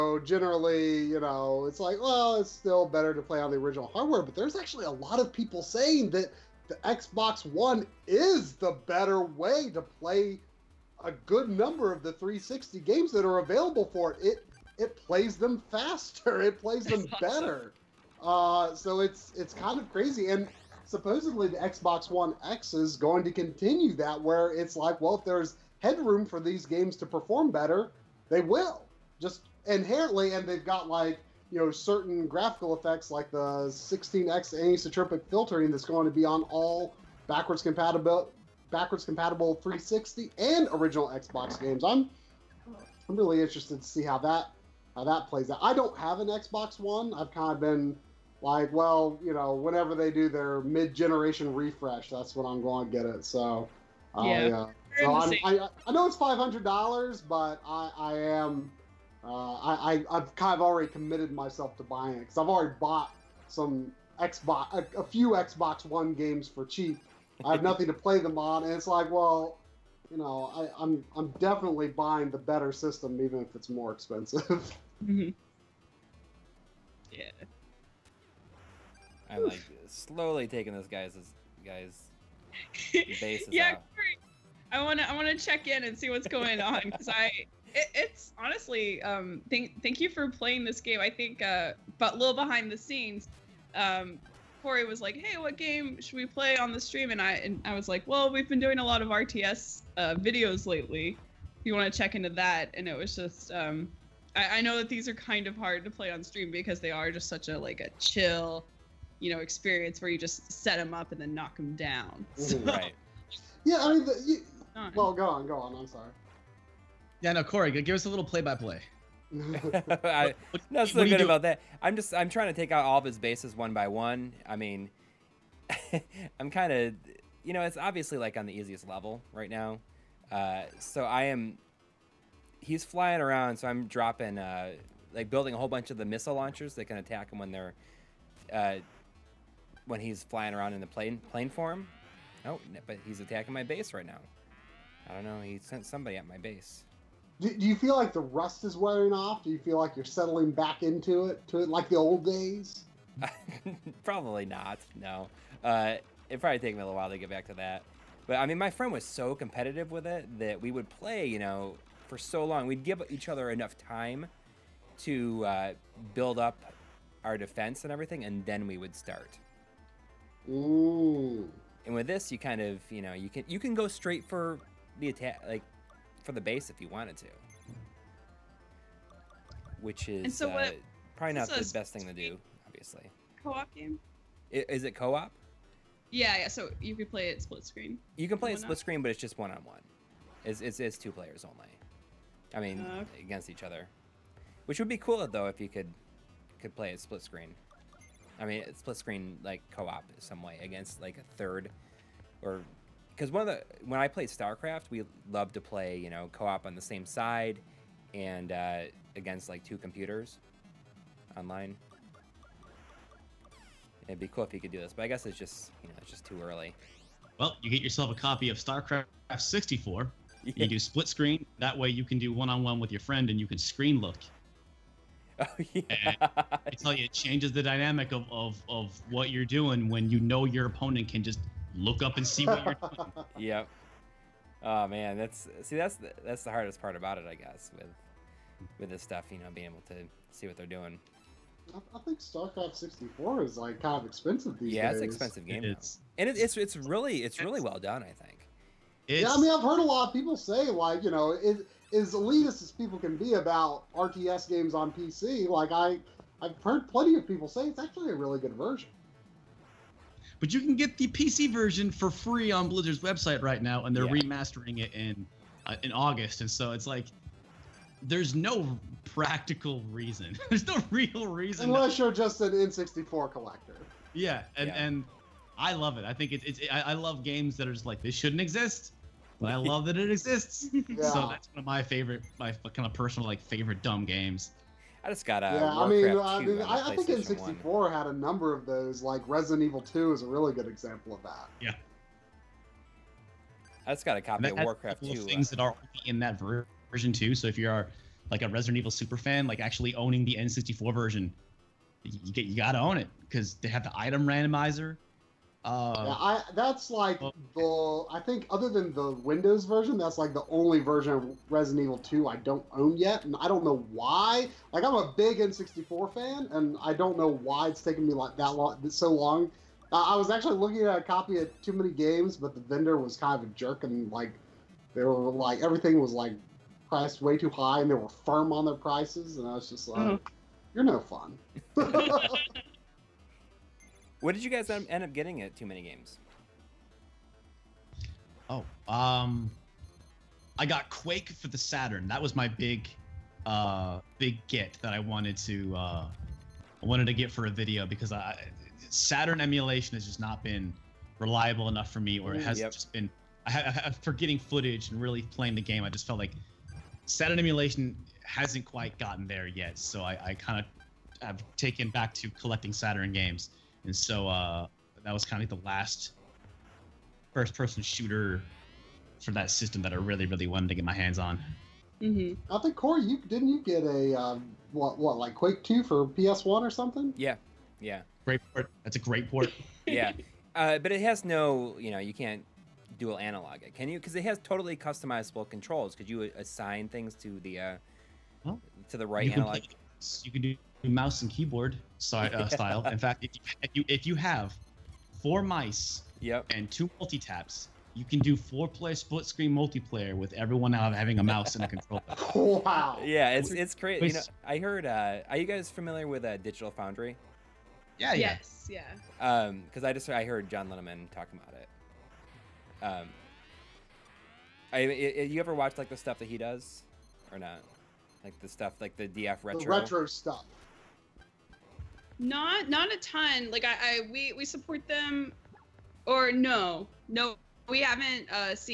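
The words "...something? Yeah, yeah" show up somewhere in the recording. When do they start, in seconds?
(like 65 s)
376 s.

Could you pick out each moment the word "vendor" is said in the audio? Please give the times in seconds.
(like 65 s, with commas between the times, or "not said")
322 s.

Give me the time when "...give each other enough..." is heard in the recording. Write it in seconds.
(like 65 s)
162 s.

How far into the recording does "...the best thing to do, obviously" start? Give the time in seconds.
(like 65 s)
181 s.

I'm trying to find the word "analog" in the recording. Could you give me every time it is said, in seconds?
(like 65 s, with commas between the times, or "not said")
383 s, 389 s.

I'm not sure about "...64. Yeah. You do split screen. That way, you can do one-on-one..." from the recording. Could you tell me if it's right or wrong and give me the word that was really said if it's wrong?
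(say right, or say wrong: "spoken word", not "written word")
right.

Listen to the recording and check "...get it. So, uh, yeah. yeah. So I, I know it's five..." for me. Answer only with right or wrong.
right.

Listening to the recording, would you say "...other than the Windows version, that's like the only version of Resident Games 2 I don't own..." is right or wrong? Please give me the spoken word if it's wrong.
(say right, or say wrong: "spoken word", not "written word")
wrong: "Evil", not "Games".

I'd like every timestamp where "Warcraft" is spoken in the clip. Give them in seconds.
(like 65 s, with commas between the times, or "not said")
285 s, 294 s.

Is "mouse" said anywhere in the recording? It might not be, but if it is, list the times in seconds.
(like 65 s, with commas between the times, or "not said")
390 s, 401 s.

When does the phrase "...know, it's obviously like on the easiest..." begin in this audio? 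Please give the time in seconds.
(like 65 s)
127 s.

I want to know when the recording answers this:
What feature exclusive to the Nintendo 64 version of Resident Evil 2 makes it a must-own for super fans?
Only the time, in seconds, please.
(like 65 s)
303 s.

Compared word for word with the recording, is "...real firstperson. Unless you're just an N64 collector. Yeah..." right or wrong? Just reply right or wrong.
wrong.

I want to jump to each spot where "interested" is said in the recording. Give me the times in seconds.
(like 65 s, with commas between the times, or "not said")
43 s.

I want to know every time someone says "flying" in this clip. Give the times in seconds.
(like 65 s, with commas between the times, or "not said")
132 s, 140 s.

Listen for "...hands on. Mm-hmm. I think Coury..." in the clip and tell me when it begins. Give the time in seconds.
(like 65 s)
370 s.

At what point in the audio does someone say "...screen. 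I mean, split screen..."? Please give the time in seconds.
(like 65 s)
197 s.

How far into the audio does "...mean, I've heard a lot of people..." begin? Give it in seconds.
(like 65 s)
249 s.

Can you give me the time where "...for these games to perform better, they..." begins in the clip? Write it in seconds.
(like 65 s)
26 s.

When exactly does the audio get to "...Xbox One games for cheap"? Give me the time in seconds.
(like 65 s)
65 s.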